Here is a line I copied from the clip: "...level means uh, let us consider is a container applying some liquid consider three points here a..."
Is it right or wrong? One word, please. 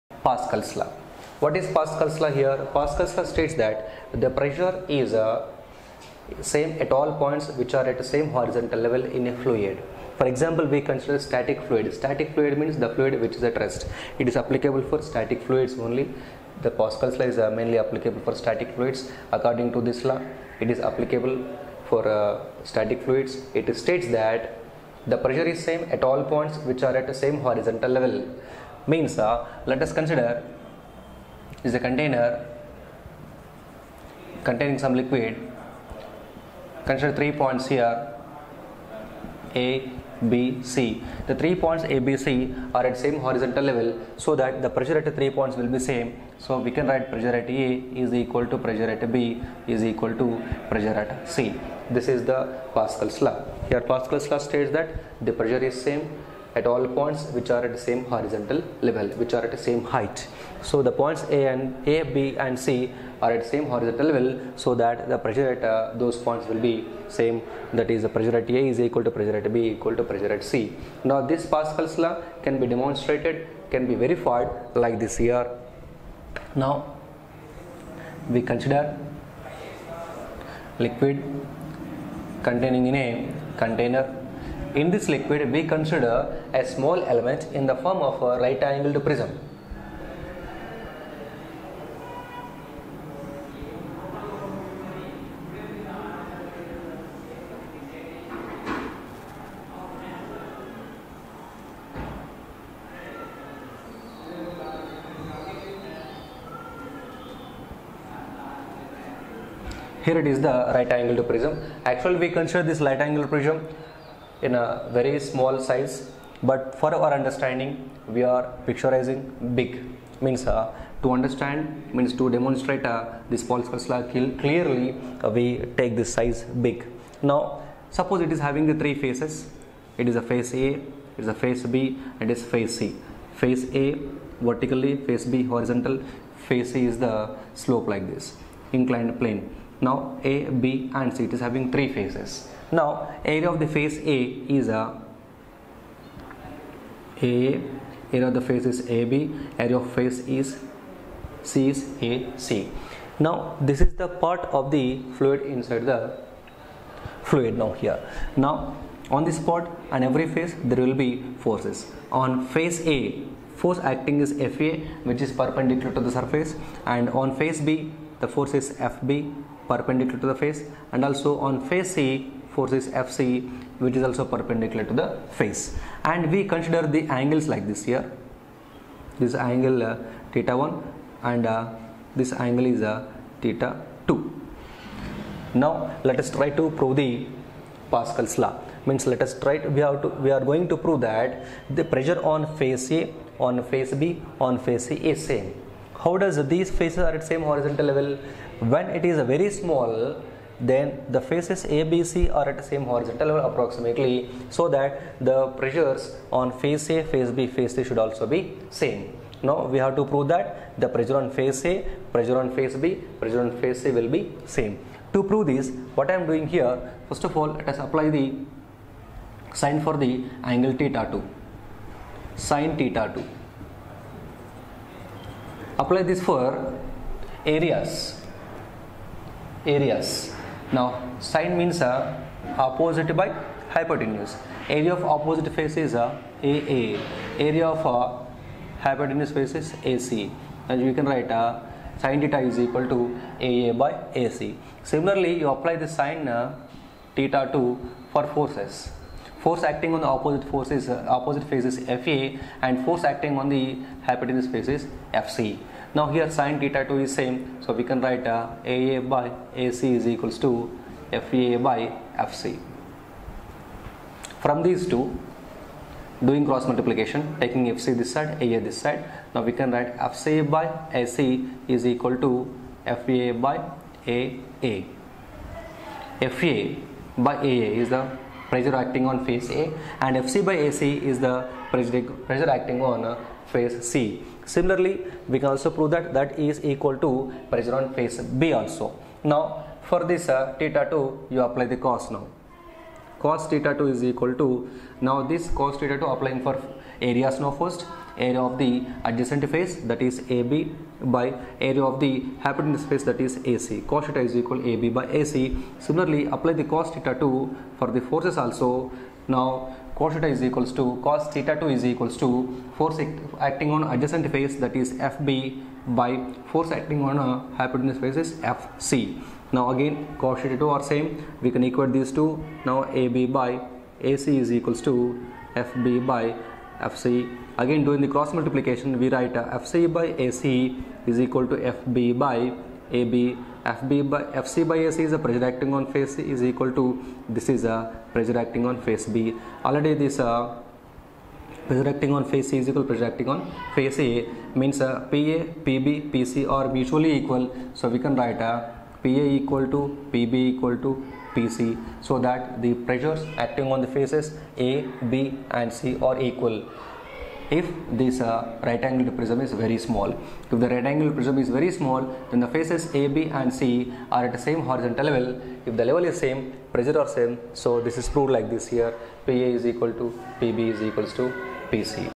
wrong.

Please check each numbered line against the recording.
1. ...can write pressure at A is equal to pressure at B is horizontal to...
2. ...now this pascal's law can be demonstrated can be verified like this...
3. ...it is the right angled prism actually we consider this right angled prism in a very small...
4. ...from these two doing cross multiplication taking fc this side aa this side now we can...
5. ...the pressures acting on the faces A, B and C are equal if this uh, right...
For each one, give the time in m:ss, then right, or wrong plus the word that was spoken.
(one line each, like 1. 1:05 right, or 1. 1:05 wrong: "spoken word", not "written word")
1. 0:46 wrong: "equal", not "horizontal"
2. 1:11 right
3. 1:50 right
4. 4:24 right
5. 5:52 right.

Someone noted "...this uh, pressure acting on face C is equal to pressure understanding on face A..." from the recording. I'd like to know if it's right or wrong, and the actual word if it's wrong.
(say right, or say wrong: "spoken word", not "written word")
wrong: "acting", not "understanding".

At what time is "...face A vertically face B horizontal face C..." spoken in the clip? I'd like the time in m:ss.
2:13.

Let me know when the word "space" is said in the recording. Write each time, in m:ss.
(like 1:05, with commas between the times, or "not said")
5:02.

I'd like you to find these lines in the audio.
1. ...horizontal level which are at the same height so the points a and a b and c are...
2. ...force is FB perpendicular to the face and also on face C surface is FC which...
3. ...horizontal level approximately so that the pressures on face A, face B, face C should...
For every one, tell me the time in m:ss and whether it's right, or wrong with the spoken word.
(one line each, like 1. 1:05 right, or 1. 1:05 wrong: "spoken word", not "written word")
1. 0:58 right
2. 2:48 wrong: "force", not "surface"
3. 3:22 right.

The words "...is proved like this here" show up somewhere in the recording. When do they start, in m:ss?
6:07.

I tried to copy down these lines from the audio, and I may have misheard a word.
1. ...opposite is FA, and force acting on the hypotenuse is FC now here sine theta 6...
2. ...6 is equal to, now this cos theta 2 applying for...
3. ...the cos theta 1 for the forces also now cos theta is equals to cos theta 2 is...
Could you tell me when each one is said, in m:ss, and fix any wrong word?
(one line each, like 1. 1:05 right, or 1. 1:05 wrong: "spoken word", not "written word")
1. 4:11 wrong: "2", not "6"
2. 4:53 wrong: "2", not "6"
3. 5:06 wrong: "2", not "1".